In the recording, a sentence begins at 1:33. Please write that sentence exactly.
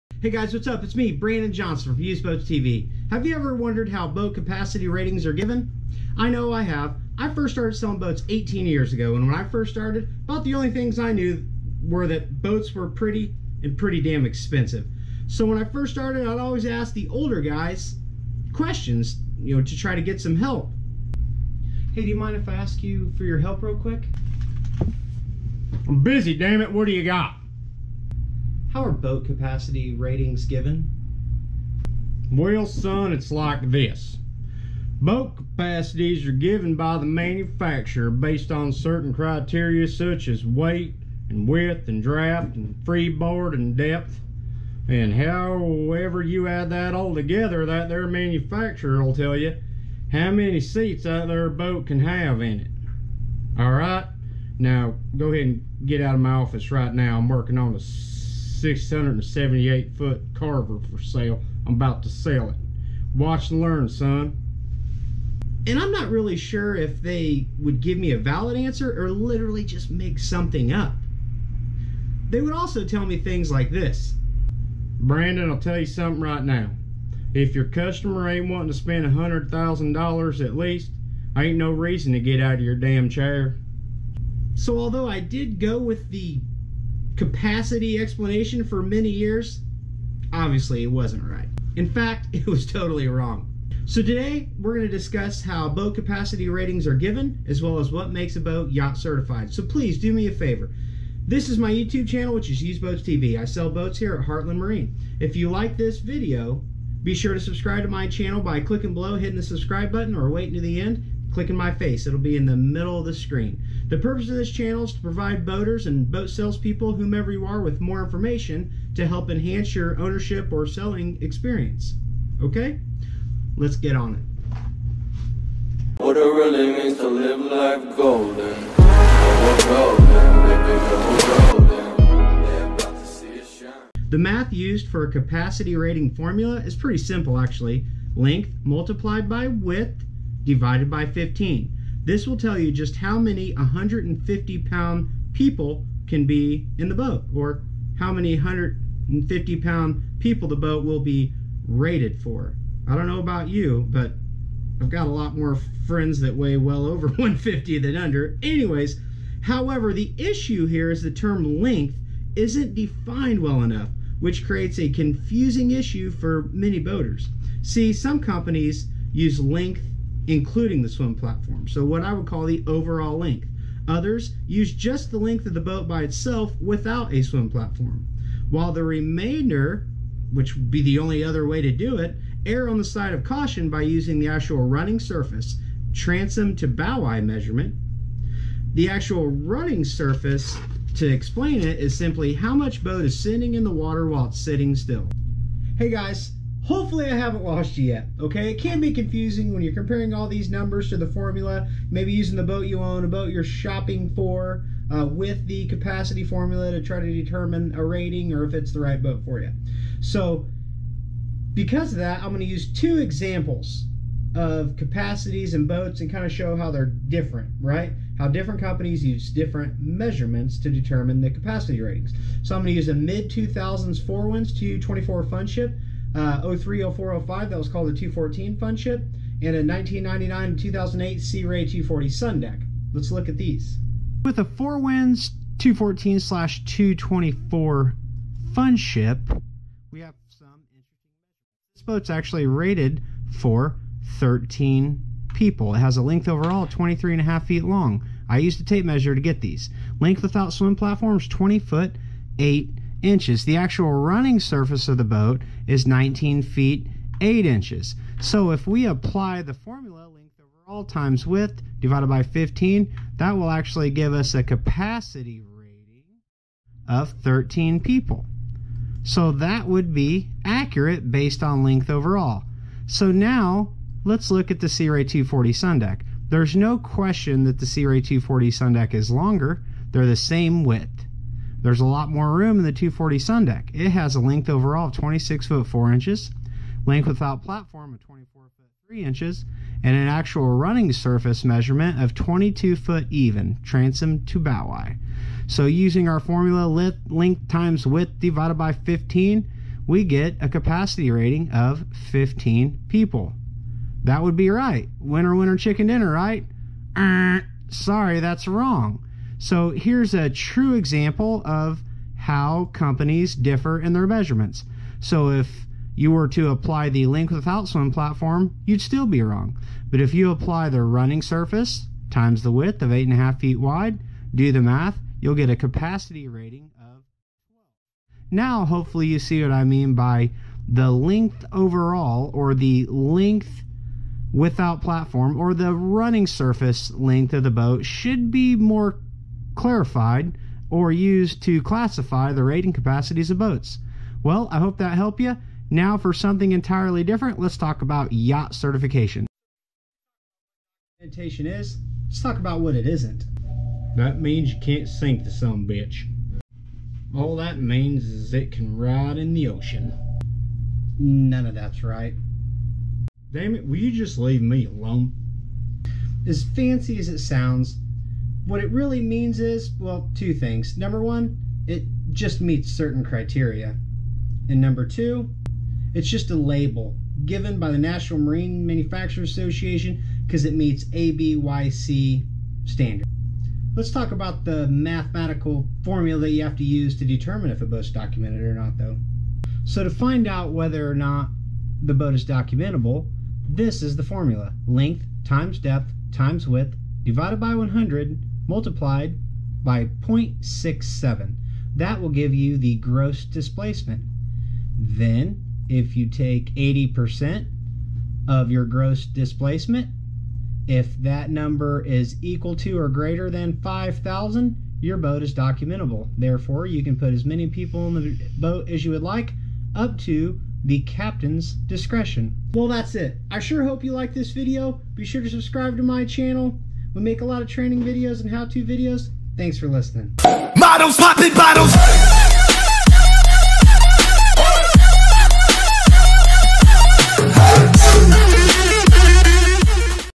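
So today, we're going to discuss how boat capacity ratings are given, as well as what makes a boat yacht certified.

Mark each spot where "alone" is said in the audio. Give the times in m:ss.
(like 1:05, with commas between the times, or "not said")
6:04.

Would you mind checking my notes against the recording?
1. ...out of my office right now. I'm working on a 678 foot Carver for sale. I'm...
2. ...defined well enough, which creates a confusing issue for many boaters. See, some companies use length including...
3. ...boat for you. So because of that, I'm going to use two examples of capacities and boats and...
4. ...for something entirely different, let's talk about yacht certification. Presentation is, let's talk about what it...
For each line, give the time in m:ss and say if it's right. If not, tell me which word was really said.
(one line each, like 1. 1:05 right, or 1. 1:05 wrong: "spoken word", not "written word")
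1. 0:55 right
2. 2:42 right
3. 3:29 right
4. 5:45 right.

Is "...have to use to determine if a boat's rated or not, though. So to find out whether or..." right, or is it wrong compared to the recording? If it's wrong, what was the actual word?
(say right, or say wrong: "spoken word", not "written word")
wrong: "documented", not "rated".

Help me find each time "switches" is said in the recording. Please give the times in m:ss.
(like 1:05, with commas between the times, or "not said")
not said.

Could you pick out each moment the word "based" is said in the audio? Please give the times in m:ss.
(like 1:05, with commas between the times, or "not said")
0:38, 4:31.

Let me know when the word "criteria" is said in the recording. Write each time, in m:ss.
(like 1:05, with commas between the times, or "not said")
0:39, 6:13.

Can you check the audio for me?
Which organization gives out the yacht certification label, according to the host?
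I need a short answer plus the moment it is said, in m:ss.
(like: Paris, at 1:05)
National Marine Manufacturers Association, at 6:17.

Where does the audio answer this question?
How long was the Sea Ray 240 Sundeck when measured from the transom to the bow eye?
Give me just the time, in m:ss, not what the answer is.
4:52.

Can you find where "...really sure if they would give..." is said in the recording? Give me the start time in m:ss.
1:06.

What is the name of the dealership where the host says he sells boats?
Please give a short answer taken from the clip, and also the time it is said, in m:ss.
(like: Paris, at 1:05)
Heartland Marine, at 1:44.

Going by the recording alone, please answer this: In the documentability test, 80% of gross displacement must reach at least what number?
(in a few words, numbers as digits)
5,000.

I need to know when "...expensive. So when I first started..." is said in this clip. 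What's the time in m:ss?
0:14.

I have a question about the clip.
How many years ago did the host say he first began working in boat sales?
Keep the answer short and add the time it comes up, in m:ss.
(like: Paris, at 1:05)
18, at 0:08.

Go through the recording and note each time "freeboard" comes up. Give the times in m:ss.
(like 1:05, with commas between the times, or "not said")
0:42.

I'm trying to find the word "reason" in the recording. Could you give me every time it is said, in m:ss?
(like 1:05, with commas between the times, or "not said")
1:21.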